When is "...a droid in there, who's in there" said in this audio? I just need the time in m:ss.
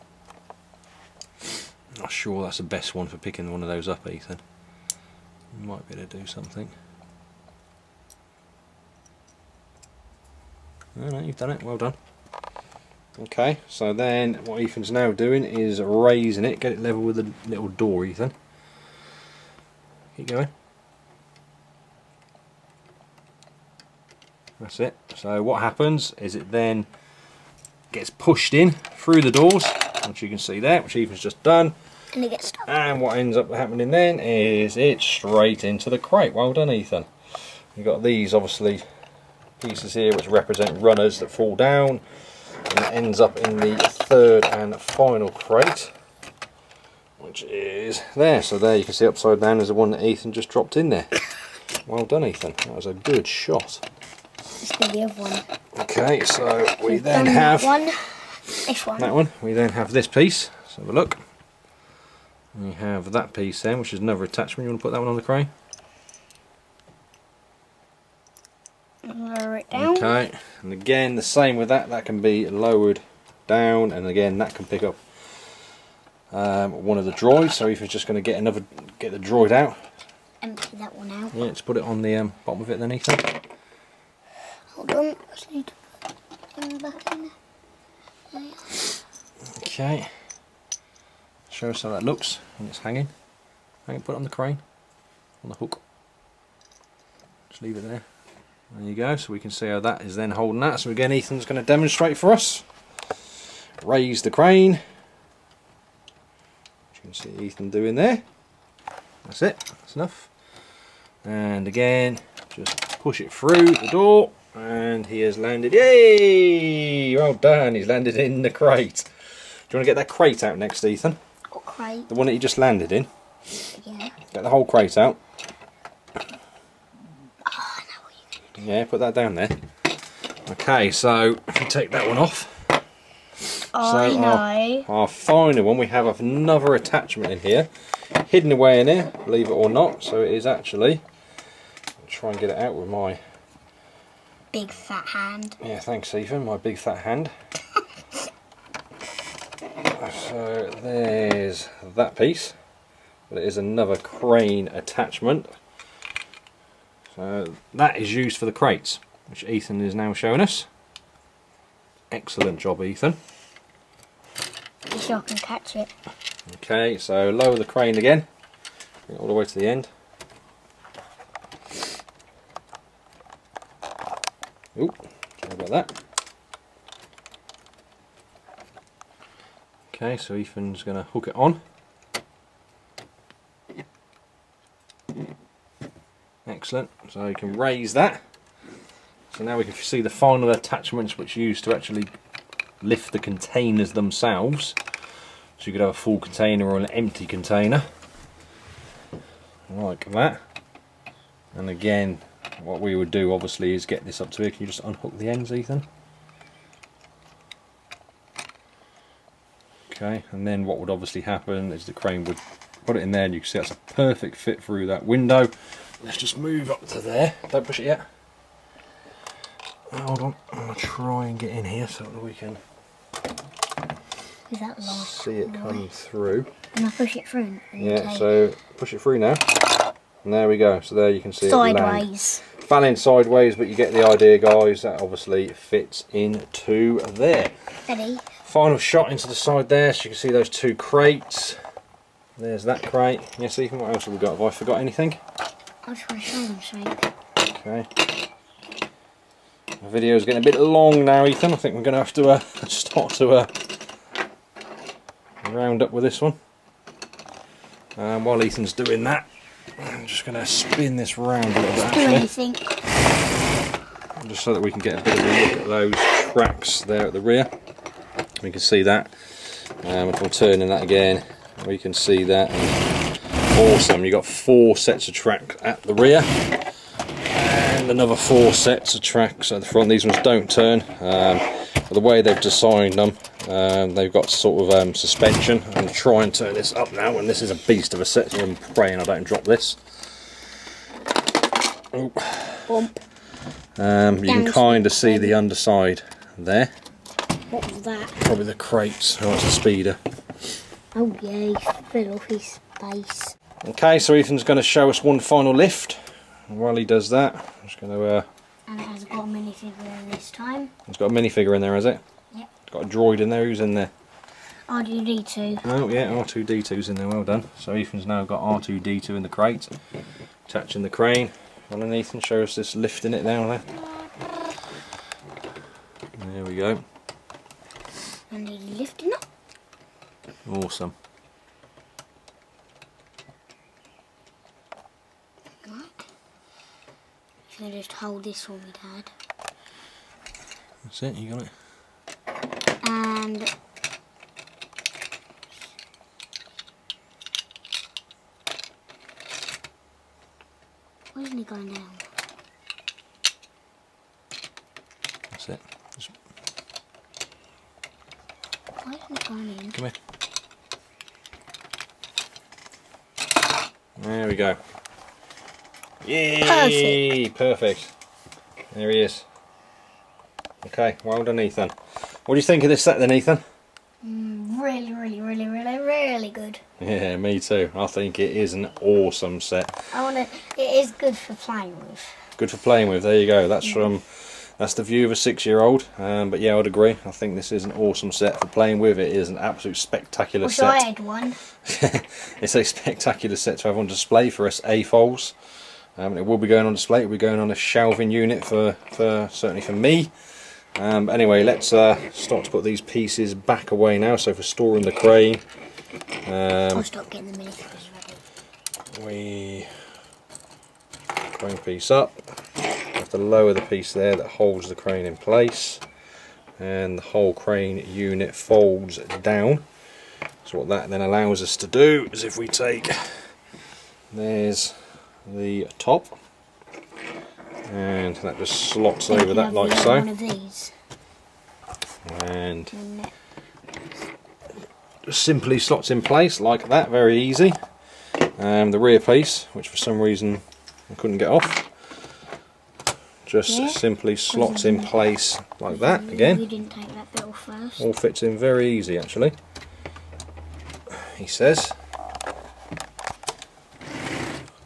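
5:12.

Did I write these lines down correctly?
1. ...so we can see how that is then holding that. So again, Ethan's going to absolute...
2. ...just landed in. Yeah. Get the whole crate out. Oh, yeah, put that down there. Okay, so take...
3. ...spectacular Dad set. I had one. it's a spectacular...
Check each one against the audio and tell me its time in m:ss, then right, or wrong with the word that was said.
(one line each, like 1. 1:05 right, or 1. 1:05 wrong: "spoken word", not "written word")
1. 1:39 wrong: "demonstrate", not "absolute"
2. 2:02 right
3. 6:29 wrong: "Wish", not "Dad".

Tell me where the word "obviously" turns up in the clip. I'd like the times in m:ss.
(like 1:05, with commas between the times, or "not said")
0:38, 3:23, 3:30, 3:55.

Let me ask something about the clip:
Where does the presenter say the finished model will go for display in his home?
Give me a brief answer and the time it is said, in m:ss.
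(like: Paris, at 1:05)
a shelving unit, at 6:37.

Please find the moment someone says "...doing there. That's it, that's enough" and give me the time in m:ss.
1:47.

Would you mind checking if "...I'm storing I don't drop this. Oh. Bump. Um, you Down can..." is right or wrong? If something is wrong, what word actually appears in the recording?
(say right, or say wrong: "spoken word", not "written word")
wrong: "praying", not "storing".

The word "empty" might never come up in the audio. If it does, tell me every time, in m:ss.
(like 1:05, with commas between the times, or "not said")
1:20, 3:16.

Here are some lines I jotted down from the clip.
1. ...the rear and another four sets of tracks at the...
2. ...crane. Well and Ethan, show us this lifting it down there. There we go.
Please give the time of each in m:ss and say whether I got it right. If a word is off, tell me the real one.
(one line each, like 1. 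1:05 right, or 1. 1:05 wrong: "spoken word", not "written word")
1. 4:35 right
2. 5:20 right.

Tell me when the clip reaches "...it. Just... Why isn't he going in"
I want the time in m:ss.
5:55.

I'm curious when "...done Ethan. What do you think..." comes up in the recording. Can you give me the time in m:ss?
6:11.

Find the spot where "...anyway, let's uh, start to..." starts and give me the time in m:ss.
6:41.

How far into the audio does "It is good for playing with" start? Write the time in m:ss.
6:20.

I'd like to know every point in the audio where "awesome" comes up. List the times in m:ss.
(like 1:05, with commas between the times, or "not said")
4:33, 5:30, 6:18, 6:27.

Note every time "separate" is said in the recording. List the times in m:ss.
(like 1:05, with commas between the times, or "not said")
not said.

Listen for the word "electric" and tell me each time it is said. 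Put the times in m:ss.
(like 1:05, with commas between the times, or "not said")
not said.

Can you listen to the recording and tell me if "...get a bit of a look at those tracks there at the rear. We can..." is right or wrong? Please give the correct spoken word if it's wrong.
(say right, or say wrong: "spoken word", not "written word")
right.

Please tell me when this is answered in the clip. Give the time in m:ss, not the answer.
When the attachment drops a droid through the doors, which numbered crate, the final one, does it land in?
0:43.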